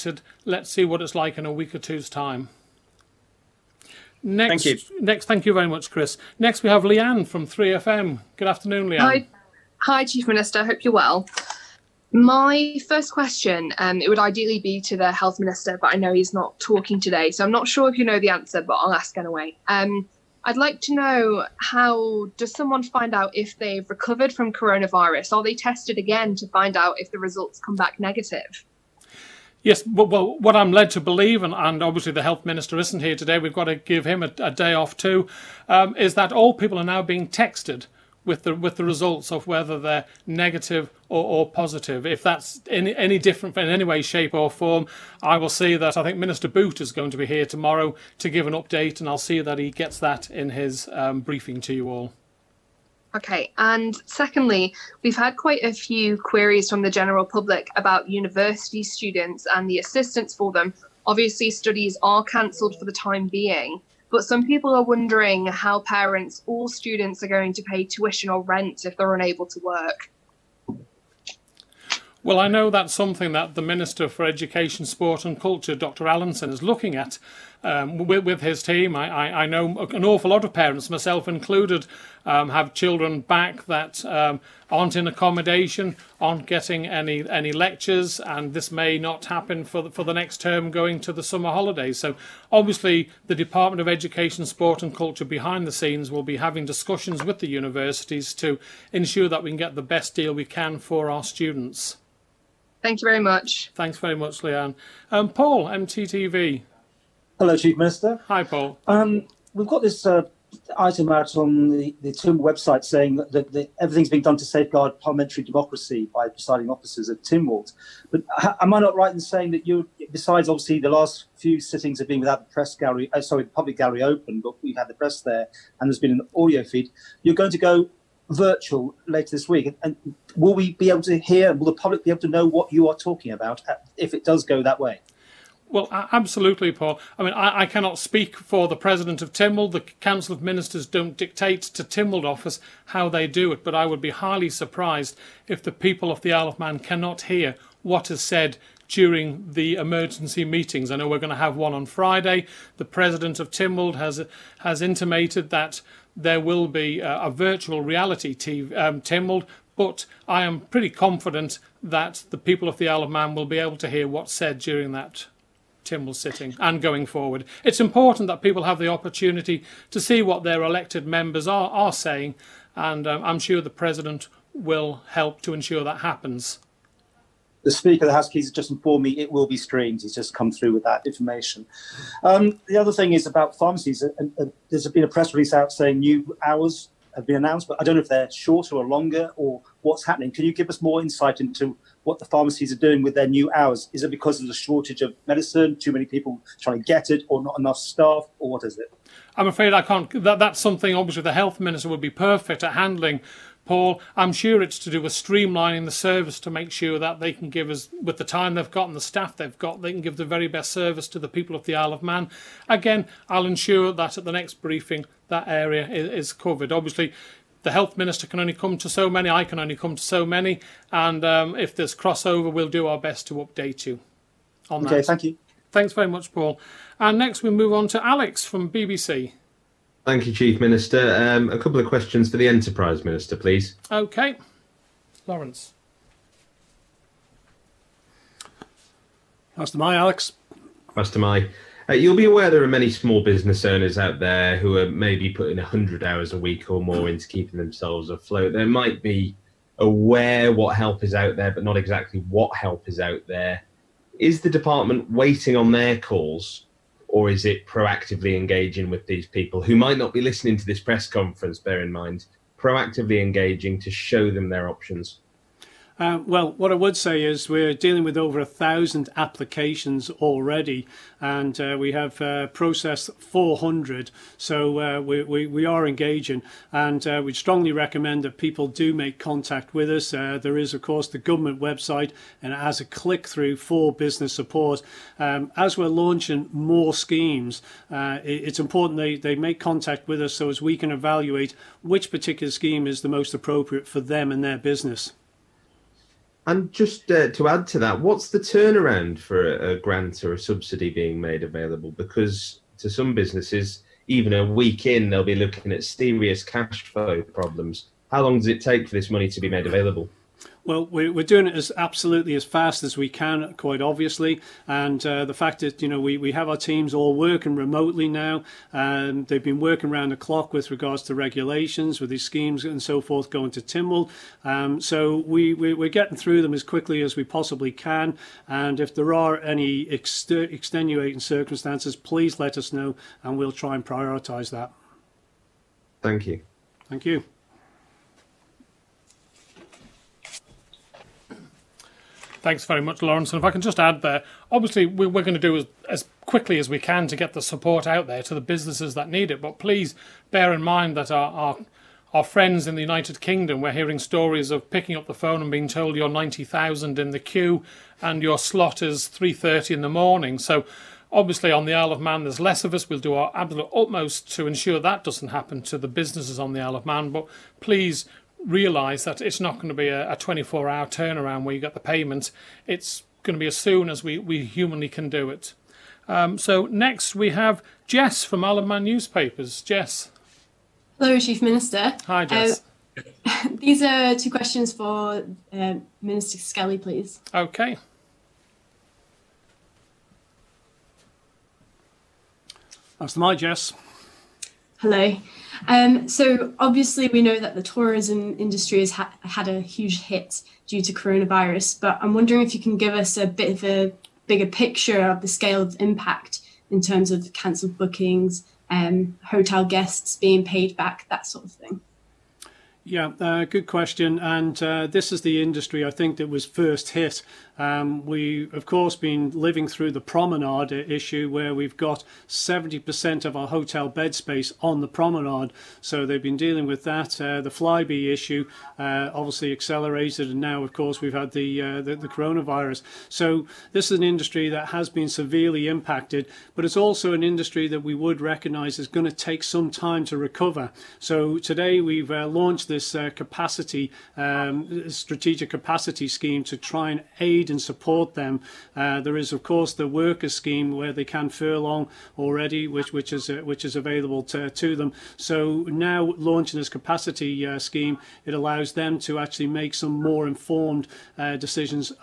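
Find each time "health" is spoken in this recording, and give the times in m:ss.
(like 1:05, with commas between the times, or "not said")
0:15, 0:32, 3:21, 3:37.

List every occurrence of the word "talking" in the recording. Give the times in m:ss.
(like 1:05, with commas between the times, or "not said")
0:16, 2:12.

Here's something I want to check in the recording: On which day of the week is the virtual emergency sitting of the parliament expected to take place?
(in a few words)
Friday.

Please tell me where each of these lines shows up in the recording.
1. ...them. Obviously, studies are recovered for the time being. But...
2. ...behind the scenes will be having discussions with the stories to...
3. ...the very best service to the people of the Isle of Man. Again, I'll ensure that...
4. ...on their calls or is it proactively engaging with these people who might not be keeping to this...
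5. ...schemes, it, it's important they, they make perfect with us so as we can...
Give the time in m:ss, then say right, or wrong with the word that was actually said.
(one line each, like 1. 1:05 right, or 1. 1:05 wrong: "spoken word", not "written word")
1. 1:00 wrong: "cancelled", not "recovered"
2. 1:35 wrong: "universities", not "stories"
3. 3:30 right
4. 4:15 wrong: "listening", not "keeping"
5. 4:46 wrong: "contact", not "perfect".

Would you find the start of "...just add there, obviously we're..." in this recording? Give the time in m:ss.
5:43.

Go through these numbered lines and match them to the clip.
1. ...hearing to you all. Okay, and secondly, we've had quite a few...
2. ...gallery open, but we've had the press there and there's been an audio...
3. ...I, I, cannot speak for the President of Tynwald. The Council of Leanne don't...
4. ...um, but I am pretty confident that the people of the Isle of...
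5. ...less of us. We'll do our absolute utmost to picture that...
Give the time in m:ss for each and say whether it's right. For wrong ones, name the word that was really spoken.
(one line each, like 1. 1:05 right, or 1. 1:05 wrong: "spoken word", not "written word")
1. 0:51 wrong: "briefing", not "hearing"
2. 2:03 right
3. 2:17 wrong: "Ministers", not "Leanne"
4. 2:38 right
5. 6:02 wrong: "ensure", not "picture".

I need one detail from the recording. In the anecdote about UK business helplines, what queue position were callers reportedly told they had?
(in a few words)
90,000.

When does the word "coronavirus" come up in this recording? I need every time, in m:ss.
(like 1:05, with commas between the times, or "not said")
0:24, 6:40, 7:12.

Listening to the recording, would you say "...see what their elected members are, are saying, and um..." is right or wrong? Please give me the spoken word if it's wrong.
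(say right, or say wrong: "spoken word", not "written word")
right.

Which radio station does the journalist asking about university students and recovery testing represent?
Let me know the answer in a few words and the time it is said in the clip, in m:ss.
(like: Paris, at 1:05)
3FM, at 0:07.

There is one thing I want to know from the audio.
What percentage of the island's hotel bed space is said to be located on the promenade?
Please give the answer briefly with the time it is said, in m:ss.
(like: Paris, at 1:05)
70%, at 7:02.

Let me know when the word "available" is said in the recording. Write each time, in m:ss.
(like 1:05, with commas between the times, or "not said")
5:01, 5:09, 7:33.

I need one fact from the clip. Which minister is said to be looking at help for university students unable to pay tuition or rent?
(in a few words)
Dr. Allinson.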